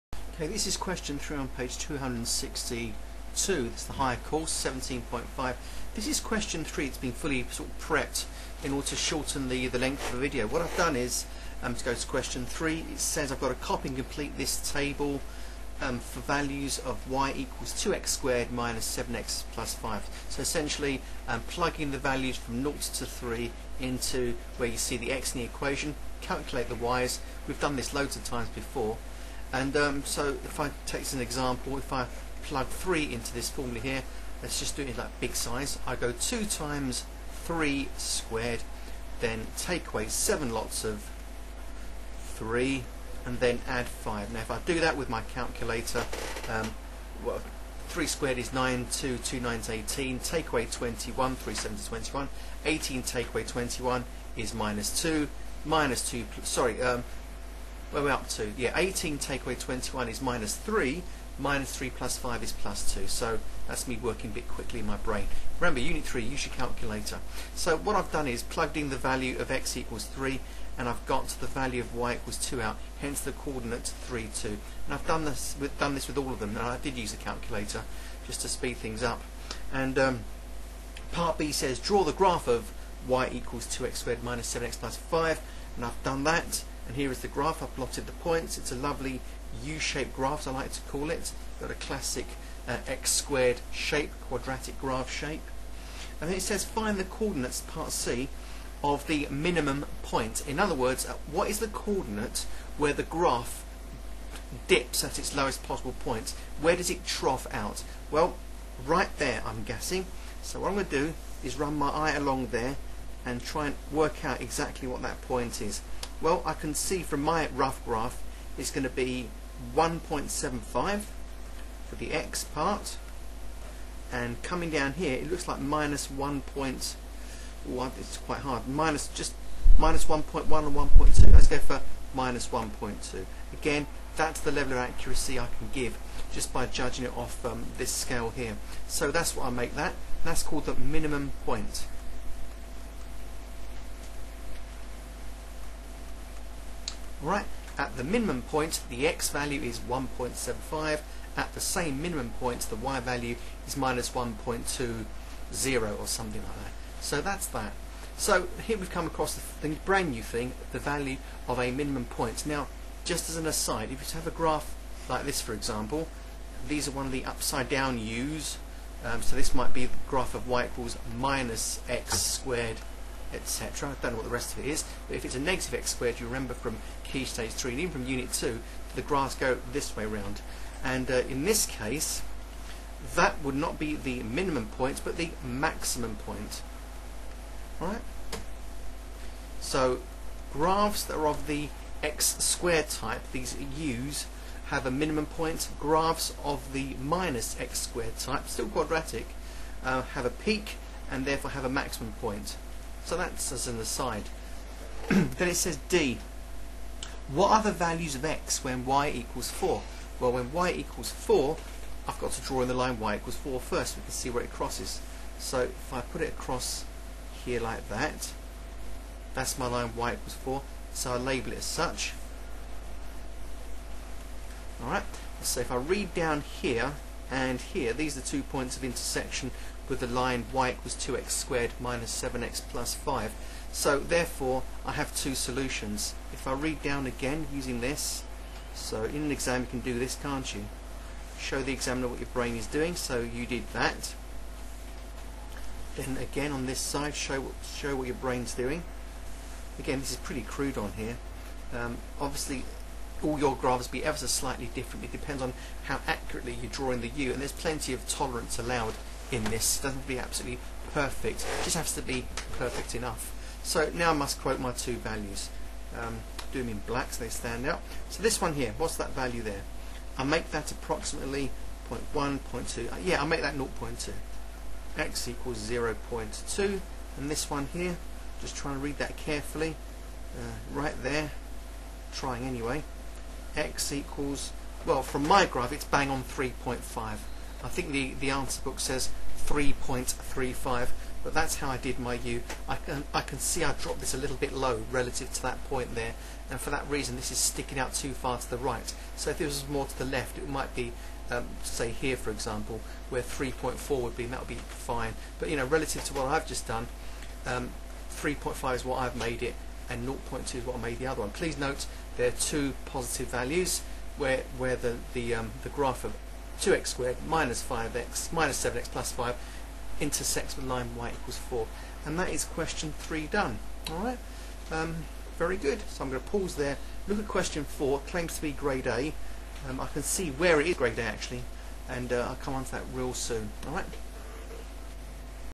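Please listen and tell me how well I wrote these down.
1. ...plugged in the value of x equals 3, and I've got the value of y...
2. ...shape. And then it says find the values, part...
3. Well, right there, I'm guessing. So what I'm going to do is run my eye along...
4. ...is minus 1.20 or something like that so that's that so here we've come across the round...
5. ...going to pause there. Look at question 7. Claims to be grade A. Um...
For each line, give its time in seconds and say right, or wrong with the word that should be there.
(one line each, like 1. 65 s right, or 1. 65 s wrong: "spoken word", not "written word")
1. 68 s right
2. 95 s wrong: "coordinates", not "values"
3. 108 s right
4. 153 s wrong: "brand", not "round"
5. 326 s wrong: "4", not "7".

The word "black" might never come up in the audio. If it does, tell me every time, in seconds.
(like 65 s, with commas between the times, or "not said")
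266 s.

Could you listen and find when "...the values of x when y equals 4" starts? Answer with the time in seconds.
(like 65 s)
207 s.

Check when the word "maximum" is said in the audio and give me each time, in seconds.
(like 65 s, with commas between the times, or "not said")
185 s, 201 s.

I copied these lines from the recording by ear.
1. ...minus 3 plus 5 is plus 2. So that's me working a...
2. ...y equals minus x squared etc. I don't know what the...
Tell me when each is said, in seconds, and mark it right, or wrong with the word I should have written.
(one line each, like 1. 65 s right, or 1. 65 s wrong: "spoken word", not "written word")
1. 61 s right
2. 170 s right.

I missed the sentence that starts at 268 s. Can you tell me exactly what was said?
So this one here, what's that value there?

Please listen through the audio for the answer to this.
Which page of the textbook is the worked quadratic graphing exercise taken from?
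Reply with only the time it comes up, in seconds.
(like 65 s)
1 s.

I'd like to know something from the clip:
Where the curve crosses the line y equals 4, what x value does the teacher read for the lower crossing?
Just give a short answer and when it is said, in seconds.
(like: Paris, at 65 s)
0.2, at 274 s.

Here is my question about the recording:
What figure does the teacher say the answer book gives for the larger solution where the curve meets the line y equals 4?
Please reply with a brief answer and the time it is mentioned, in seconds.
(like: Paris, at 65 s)
3.35, at 289 s.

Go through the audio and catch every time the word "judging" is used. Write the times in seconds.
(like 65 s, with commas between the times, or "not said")
136 s.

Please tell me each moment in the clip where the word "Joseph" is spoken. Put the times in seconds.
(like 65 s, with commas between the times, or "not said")
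not said.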